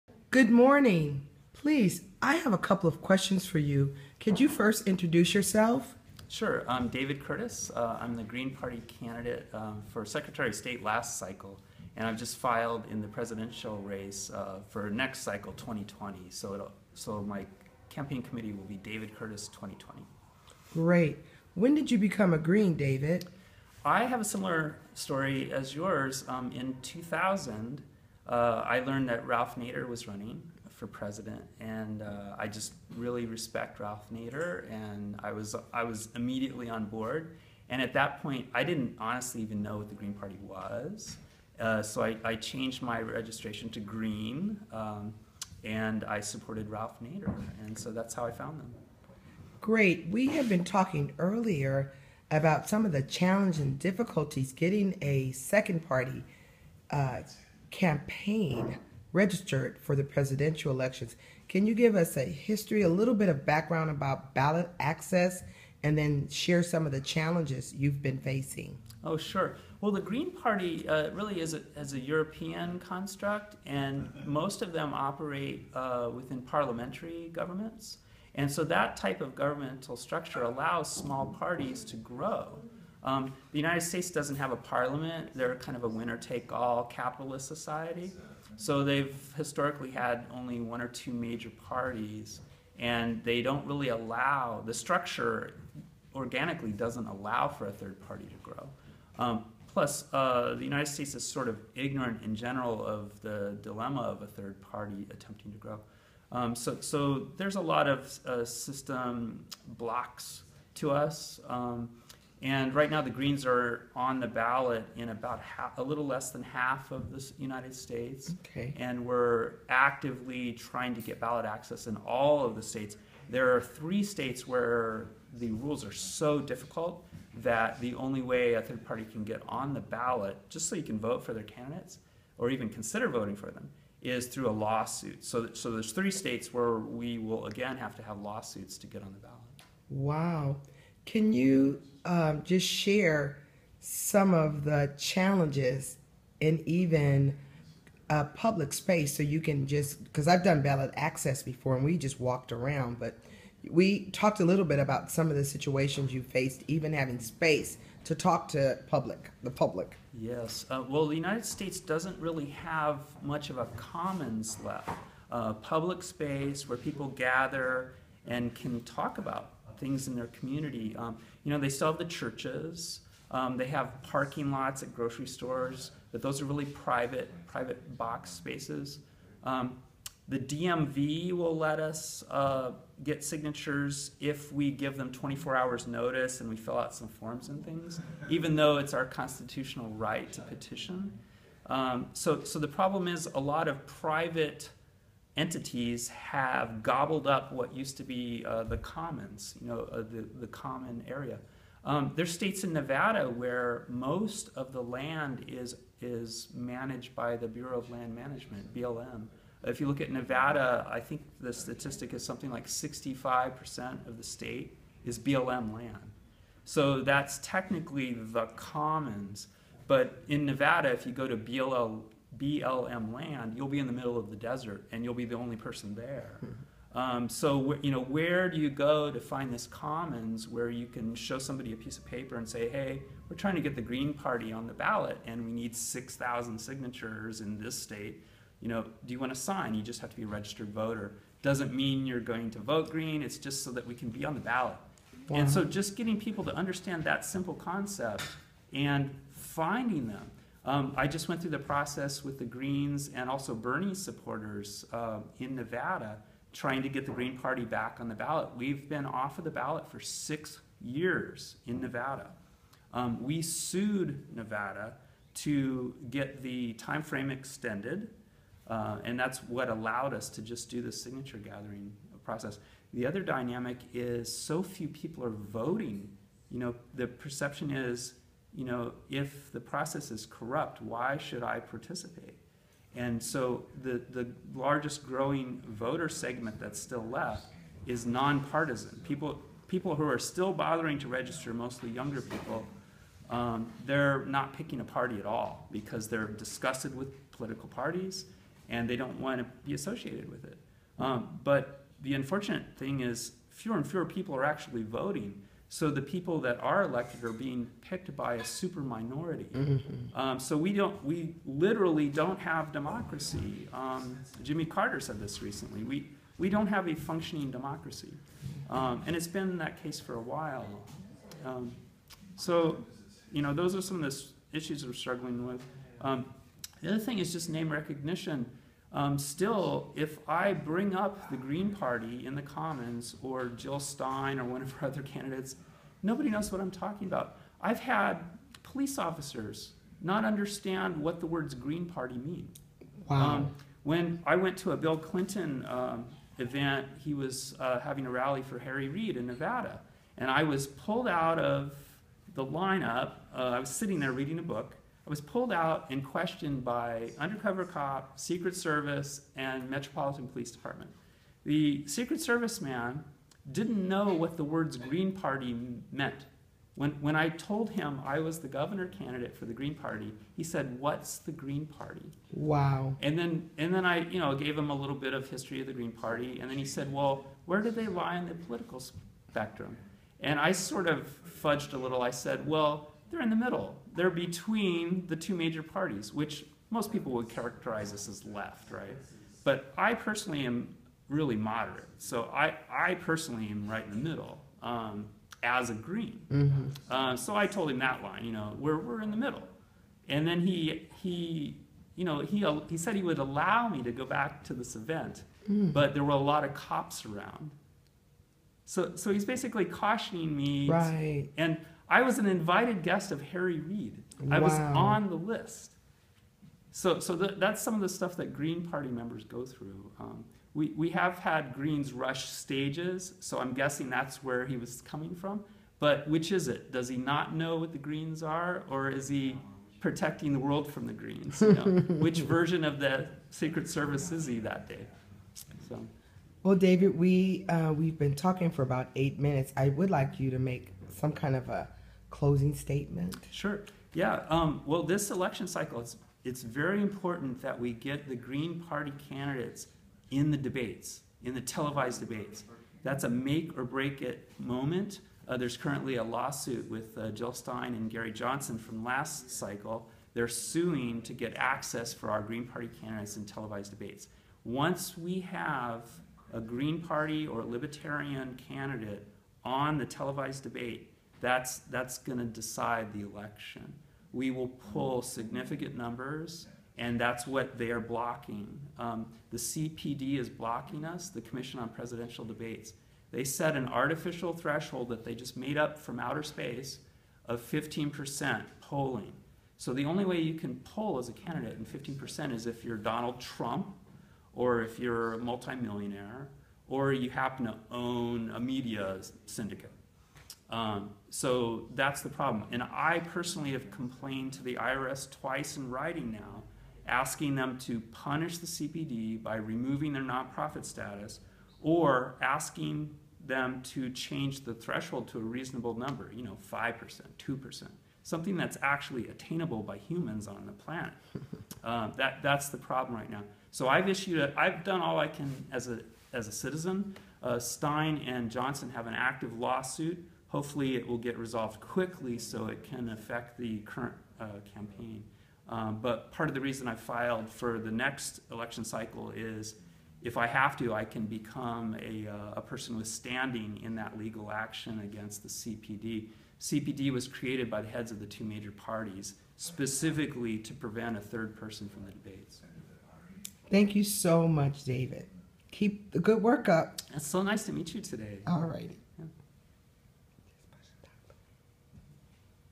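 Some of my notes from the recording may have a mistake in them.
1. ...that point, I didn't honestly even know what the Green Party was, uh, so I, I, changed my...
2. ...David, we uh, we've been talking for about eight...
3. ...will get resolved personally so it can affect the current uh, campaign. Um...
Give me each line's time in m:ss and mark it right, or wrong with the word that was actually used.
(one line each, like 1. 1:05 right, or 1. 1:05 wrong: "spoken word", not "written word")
1. 0:37 right
2. 7:16 right
3. 8:50 wrong: "quickly", not "personally".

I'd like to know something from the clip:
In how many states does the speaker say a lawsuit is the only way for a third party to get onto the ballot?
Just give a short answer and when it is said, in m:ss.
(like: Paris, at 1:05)
3, at 2:03.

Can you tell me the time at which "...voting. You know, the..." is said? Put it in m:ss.
4:35.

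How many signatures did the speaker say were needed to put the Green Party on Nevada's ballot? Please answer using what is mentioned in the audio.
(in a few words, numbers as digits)
6,000.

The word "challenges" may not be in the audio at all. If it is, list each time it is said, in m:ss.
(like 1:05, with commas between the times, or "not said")
0:53, 1:07, 2:24.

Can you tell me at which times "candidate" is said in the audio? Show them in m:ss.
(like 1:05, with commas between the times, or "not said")
0:08, 2:11, 5:35, 6:08, 7:29, 7:42, 7:48, 8:11.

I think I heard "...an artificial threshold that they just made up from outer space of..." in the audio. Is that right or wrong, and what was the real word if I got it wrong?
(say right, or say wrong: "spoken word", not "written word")
right.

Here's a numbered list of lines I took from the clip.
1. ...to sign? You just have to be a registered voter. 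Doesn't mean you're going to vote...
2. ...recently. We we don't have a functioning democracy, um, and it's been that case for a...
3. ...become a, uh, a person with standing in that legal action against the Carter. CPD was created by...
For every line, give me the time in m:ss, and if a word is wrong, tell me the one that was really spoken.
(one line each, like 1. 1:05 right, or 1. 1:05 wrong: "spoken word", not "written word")
1. 3:59 right
2. 5:15 right
3. 9:01 wrong: "CPD", not "Carter".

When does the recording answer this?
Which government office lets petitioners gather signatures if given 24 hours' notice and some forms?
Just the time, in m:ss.
3:00.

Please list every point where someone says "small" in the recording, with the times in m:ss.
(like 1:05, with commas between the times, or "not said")
1:20.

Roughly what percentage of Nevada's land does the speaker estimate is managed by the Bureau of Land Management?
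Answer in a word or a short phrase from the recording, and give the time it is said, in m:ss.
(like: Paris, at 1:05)
65%, at 3:32.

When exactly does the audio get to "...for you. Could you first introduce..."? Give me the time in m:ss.
0:03.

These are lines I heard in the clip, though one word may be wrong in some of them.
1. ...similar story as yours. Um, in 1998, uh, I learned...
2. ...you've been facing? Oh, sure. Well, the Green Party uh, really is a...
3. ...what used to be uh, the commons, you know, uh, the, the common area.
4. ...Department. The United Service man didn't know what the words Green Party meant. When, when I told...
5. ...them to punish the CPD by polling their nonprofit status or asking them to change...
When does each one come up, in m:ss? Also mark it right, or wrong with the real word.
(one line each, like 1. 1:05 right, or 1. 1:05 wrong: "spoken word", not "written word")
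1. 0:24 wrong: "2000", not "1998"
2. 1:07 right
3. 3:17 right
4. 6:00 wrong: "Secret", not "United"
5. 8:27 wrong: "removing", not "polling".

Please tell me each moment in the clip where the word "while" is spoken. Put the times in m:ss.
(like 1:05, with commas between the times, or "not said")
5:20.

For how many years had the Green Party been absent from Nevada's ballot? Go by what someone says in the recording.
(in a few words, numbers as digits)
6 years.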